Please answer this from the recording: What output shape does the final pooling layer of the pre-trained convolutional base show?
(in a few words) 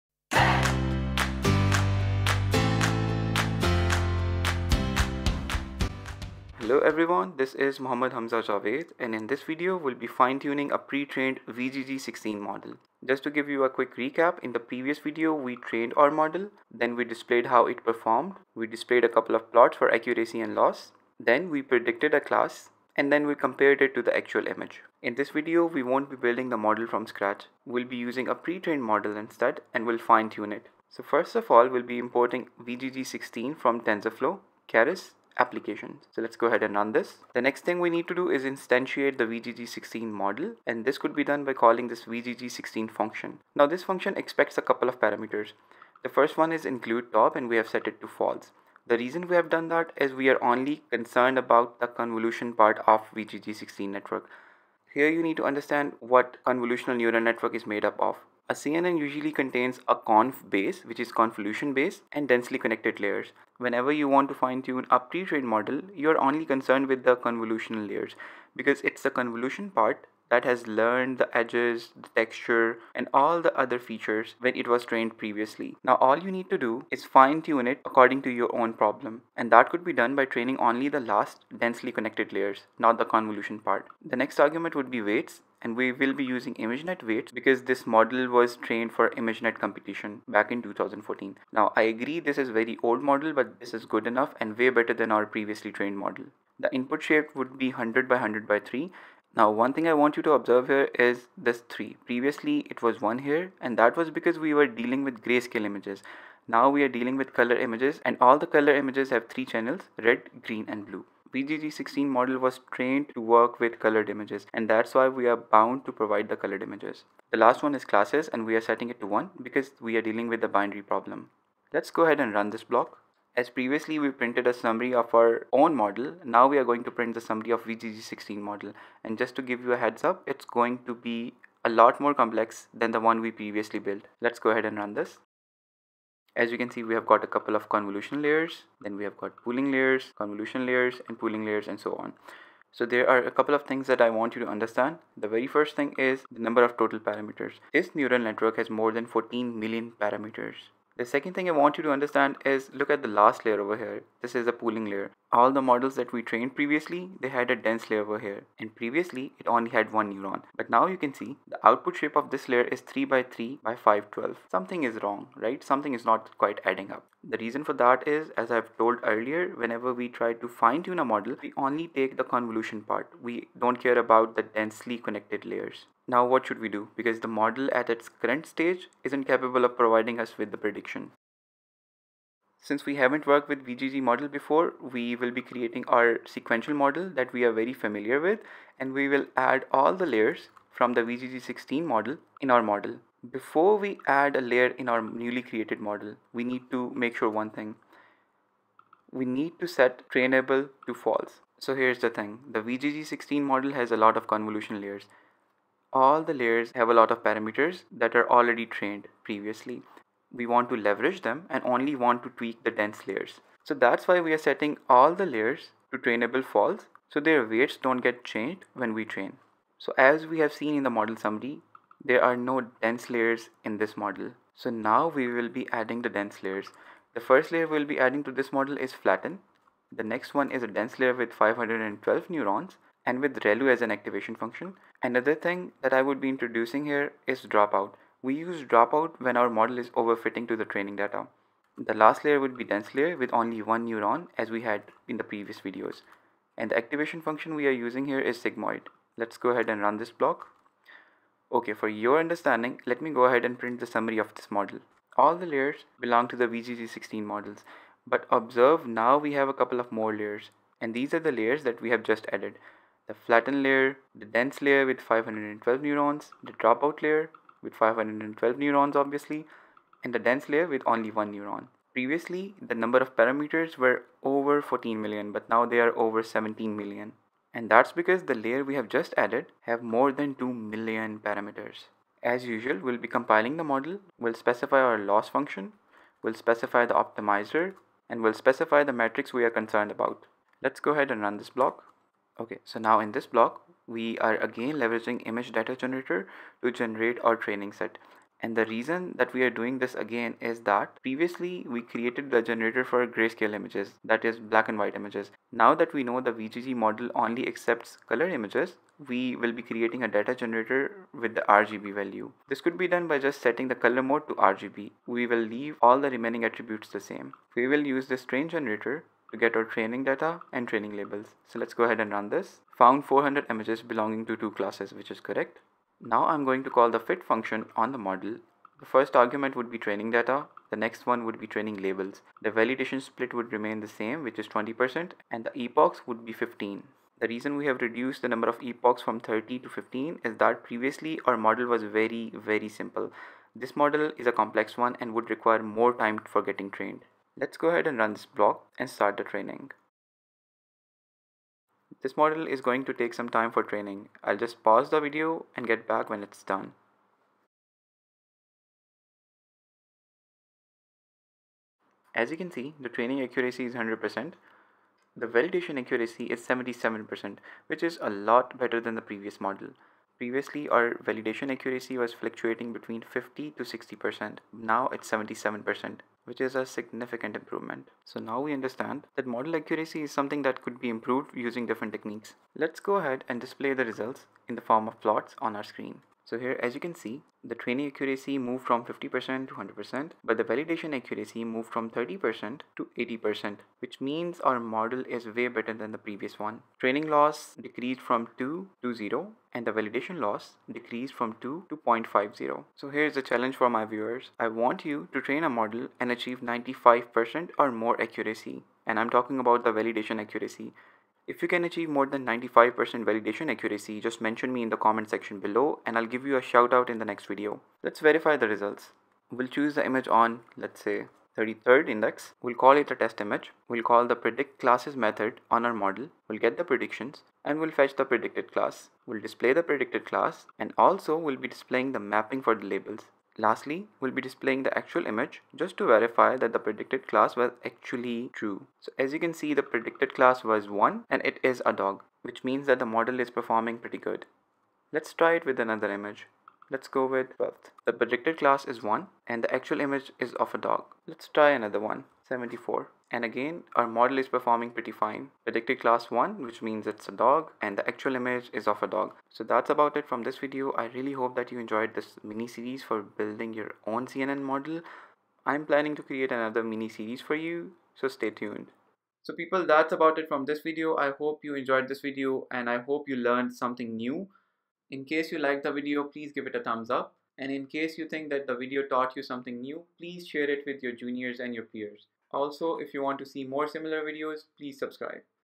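3 by 3 by 512.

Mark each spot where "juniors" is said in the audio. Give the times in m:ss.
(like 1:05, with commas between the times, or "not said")
8:00.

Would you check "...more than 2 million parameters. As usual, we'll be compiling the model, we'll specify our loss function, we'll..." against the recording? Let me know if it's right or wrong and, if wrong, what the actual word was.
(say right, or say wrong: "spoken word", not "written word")
right.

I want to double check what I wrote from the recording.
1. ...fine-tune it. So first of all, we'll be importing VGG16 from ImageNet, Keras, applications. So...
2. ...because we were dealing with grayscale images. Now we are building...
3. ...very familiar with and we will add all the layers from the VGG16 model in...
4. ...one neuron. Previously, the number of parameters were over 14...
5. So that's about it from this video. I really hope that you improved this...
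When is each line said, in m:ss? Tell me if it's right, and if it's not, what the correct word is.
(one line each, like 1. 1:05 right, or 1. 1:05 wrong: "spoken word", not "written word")
1. 0:29 wrong: "TensorFlow", not "ImageNet"
2. 1:44 wrong: "dealing", not "building"
3. 3:07 right
4. 4:31 right
5. 7:39 wrong: "enjoyed", not "improved".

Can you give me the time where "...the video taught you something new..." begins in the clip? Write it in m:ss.
7:58.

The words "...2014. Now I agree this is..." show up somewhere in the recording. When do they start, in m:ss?
1:30.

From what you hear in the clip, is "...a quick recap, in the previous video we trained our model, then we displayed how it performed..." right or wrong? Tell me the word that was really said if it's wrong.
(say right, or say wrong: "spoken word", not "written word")
right.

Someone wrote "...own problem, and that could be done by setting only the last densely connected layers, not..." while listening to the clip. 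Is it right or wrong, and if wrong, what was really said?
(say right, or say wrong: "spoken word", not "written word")
wrong: "training", not "setting".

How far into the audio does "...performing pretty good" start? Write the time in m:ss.
7:23.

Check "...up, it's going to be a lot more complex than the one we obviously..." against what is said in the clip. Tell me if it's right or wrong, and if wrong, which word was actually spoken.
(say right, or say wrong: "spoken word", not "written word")
wrong: "previously", not "obviously".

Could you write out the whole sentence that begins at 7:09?
We'll display the predicted class and also we'll be displaying the mapping for the labels.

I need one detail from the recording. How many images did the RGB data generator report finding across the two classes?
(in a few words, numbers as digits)
400.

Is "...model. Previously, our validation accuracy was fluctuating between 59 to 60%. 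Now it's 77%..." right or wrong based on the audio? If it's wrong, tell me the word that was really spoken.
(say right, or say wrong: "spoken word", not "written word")
wrong: "50", not "59".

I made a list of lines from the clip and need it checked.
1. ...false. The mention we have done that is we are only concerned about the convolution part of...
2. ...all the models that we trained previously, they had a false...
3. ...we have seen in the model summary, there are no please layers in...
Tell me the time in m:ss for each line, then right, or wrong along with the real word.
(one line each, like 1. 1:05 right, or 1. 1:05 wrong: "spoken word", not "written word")
1. 0:48 wrong: "reason", not "mention"
2. 2:35 wrong: "dense", not "false"
3. 3:40 wrong: "dense", not "please".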